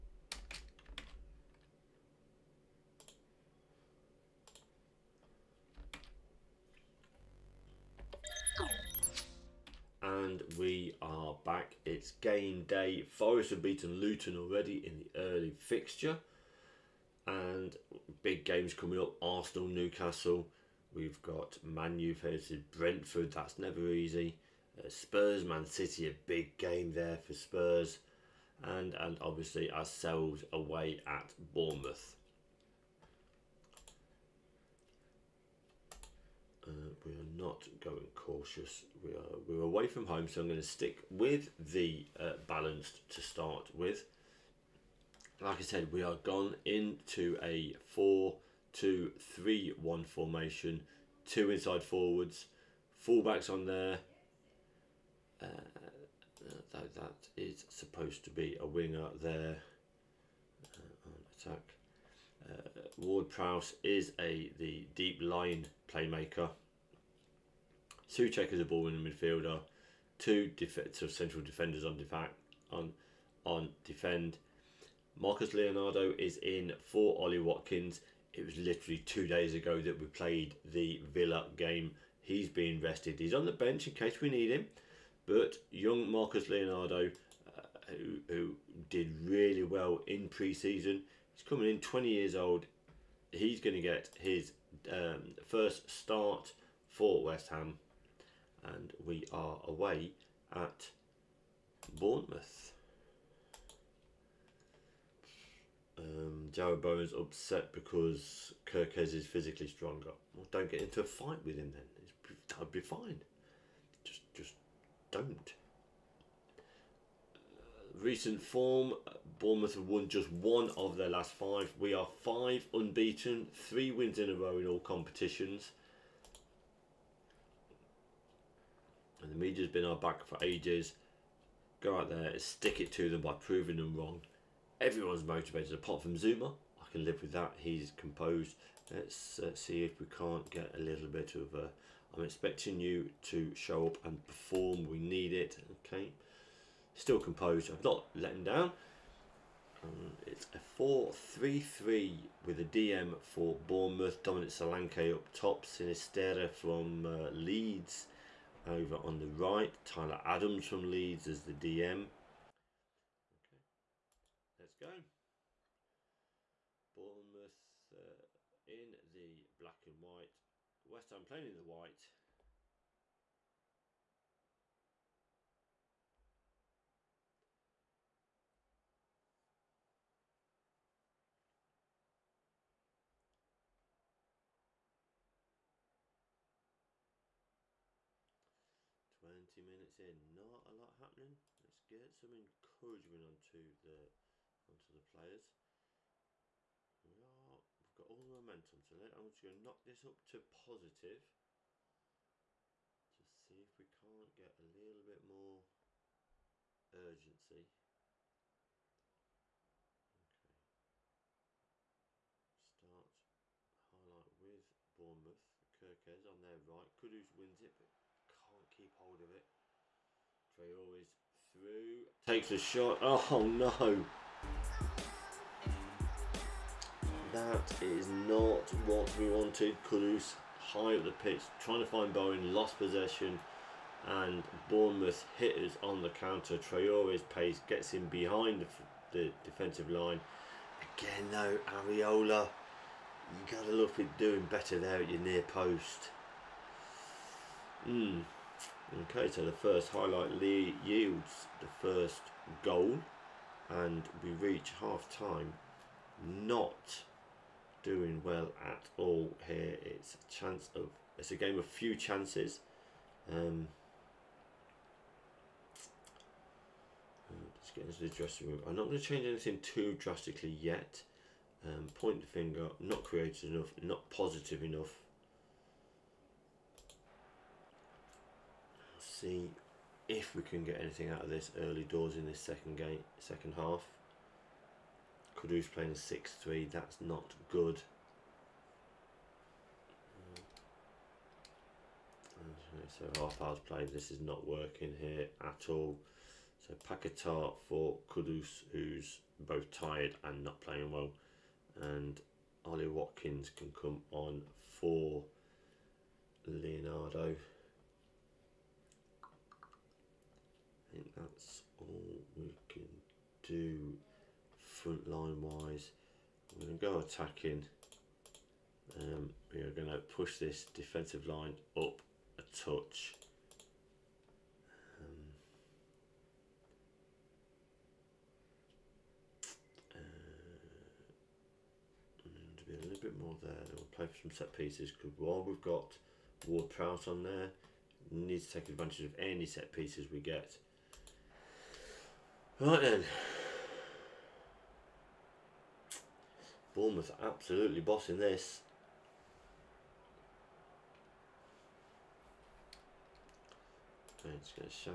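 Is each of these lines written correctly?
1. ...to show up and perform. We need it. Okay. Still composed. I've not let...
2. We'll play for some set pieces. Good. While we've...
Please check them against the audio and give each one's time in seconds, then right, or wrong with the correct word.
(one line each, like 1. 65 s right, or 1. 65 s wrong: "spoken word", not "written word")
1. 143 s right
2. 333 s right.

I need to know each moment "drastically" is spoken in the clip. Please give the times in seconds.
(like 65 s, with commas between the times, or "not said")
269 s.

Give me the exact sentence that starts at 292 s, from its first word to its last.
So half hours played, this is not working here at all.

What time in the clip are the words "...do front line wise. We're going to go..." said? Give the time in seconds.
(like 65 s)
313 s.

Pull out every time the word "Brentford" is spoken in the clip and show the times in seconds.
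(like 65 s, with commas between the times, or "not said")
22 s.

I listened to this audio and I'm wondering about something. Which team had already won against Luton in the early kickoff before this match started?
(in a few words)
Forest.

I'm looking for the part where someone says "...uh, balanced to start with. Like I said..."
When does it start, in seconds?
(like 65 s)
42 s.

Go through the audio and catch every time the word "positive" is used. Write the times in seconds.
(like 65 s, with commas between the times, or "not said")
200 s, 274 s.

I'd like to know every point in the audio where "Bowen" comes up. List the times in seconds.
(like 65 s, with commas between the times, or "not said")
106 s, 232 s.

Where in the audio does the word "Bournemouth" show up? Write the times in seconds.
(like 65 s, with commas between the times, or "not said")
31 s, 101 s, 119 s, 153 s, 166 s, 214 s, 234 s, 346 s.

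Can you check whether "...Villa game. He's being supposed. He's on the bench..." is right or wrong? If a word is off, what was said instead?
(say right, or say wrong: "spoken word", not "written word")
wrong: "rested", not "supposed".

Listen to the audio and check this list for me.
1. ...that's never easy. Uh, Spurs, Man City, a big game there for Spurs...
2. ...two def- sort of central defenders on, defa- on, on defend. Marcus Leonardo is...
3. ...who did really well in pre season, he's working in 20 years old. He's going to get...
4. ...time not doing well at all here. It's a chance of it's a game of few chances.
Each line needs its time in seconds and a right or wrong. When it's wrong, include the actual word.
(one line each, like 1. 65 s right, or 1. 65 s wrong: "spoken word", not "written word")
1. 23 s right
2. 70 s right
3. 88 s wrong: "coming", not "working"
4. 255 s right.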